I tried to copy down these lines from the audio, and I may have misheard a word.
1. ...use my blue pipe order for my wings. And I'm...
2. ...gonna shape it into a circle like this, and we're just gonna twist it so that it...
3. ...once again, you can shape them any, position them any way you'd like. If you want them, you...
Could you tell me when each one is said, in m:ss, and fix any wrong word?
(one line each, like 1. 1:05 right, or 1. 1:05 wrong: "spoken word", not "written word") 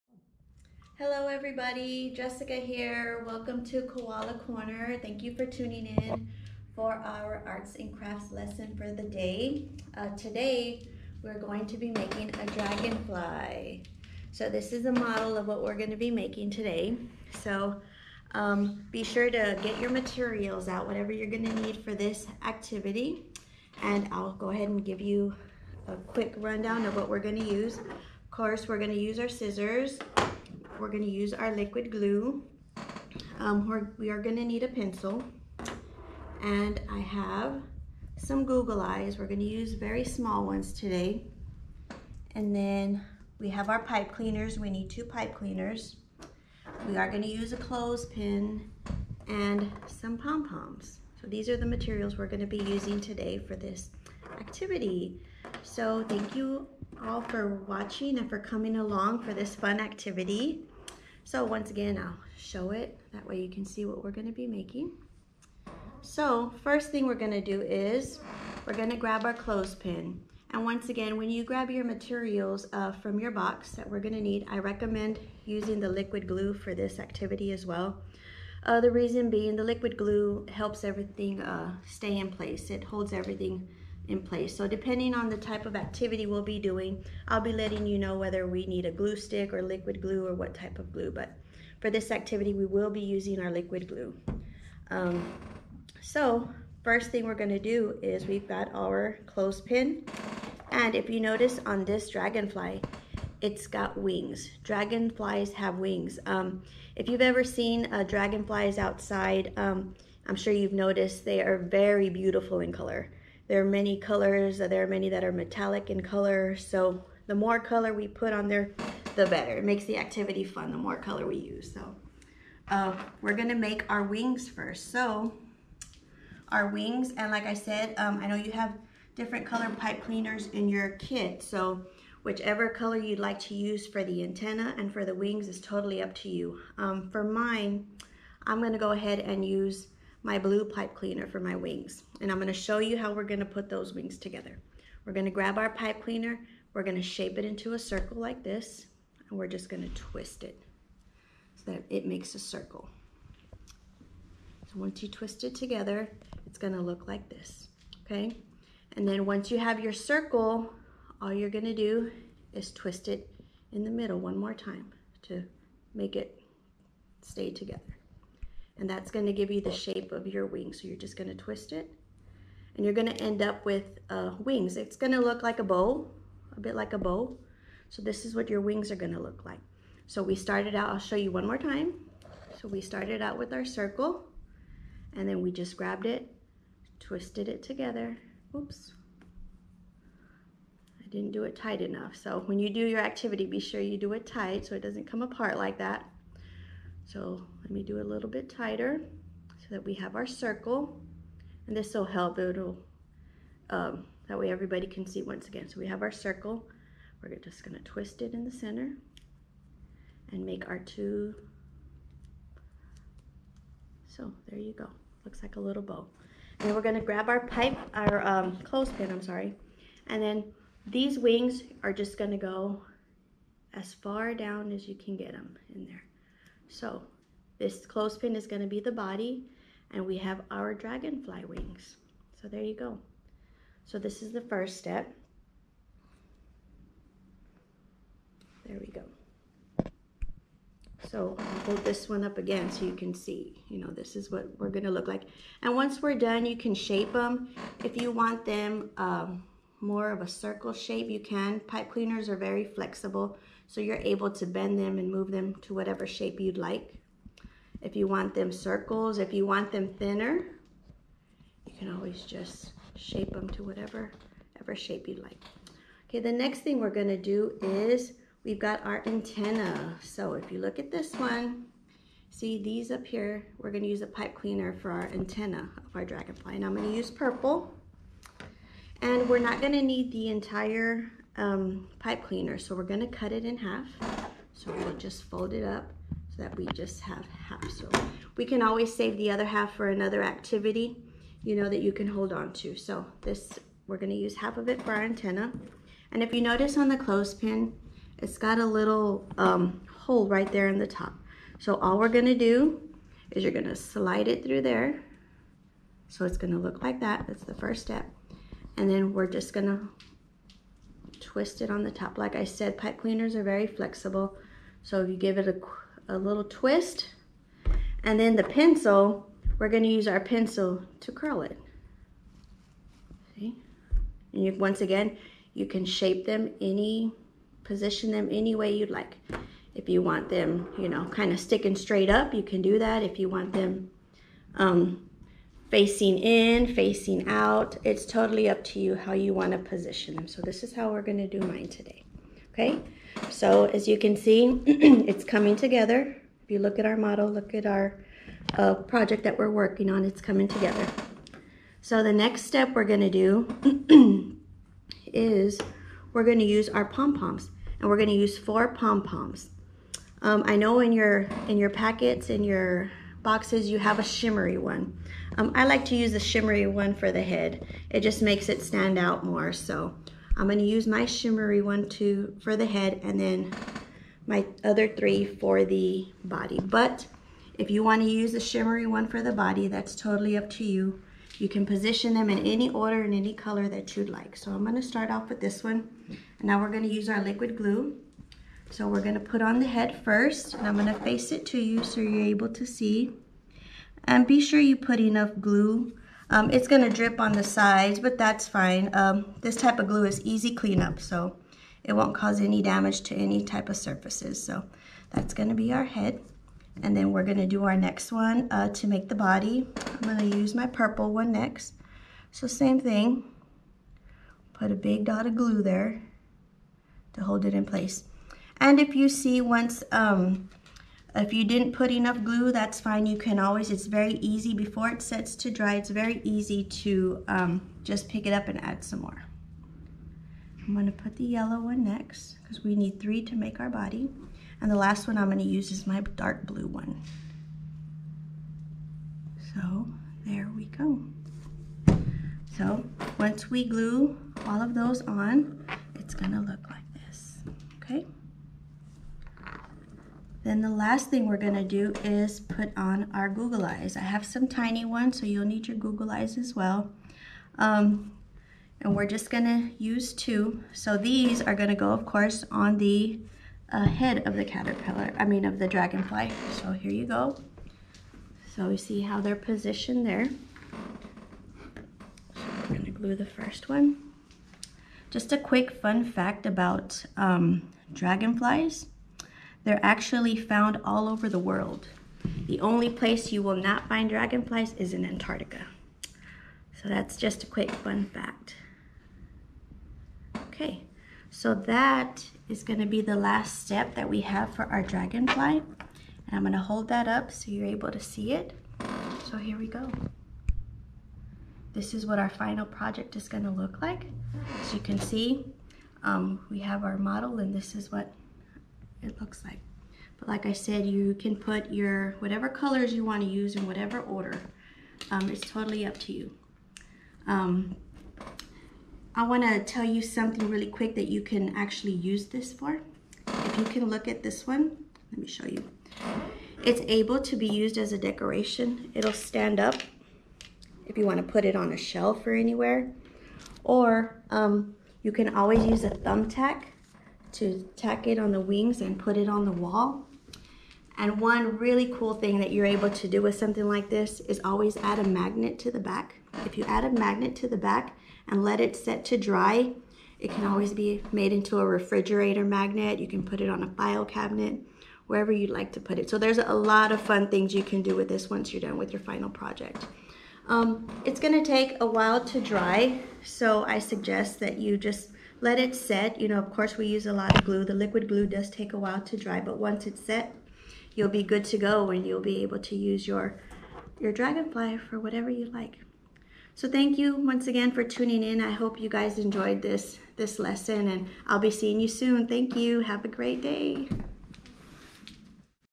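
1. 2:19 wrong: "cleaner", not "order"
2. 2:26 right
3. 5:24 right.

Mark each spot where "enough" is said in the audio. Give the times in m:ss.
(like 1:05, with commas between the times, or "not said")
3:11, 6:35, 7:01.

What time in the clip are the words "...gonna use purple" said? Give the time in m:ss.
4:36.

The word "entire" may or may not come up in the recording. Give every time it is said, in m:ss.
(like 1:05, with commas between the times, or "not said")
4:40.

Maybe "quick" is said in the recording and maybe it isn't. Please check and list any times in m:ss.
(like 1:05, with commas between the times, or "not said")
0:25, 7:55, 8:07, 8:40.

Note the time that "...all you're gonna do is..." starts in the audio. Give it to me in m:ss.
2:41.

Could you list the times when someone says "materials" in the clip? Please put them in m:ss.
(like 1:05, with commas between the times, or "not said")
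0:19, 0:51, 1:11.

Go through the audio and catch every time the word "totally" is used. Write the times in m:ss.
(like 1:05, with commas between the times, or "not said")
2:15, 5:38, 6:19, 8:35.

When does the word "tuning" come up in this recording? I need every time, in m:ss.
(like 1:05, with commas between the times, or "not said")
0:05, 9:37.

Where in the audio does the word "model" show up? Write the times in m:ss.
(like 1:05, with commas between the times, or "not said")
0:14, 5:46, 8:26.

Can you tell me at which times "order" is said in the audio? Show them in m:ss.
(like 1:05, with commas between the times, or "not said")
6:22, 8:34.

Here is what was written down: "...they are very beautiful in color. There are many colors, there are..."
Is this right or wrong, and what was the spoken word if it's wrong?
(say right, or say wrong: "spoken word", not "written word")
right.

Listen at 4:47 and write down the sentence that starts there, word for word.
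So we can always save the other half for another activity, you know, that you can hold on to.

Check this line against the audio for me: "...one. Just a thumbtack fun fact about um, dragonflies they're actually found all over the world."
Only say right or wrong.
wrong.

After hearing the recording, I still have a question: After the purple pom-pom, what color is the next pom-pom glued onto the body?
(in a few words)
Yellow.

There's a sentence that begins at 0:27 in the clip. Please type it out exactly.
Of course, we're gonna use our scissors we're going to use our liquid glue.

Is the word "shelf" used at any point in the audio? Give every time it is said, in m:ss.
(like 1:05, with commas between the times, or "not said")
8:51.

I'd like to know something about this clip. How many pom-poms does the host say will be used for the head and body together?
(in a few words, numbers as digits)
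4.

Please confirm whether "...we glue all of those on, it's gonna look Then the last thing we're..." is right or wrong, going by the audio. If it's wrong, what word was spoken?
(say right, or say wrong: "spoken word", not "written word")
right.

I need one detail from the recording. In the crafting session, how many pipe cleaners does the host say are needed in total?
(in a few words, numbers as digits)
2.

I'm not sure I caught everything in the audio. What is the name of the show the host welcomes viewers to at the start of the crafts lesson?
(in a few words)
Koala Corner.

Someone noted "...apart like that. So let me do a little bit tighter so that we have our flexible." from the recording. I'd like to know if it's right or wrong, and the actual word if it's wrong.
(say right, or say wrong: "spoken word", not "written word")
wrong: "circle", not "flexible".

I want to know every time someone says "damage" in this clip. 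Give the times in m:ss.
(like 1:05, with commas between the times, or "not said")
6:42.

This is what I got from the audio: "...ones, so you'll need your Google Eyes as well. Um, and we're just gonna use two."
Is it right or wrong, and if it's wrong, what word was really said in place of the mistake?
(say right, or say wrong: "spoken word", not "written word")
right.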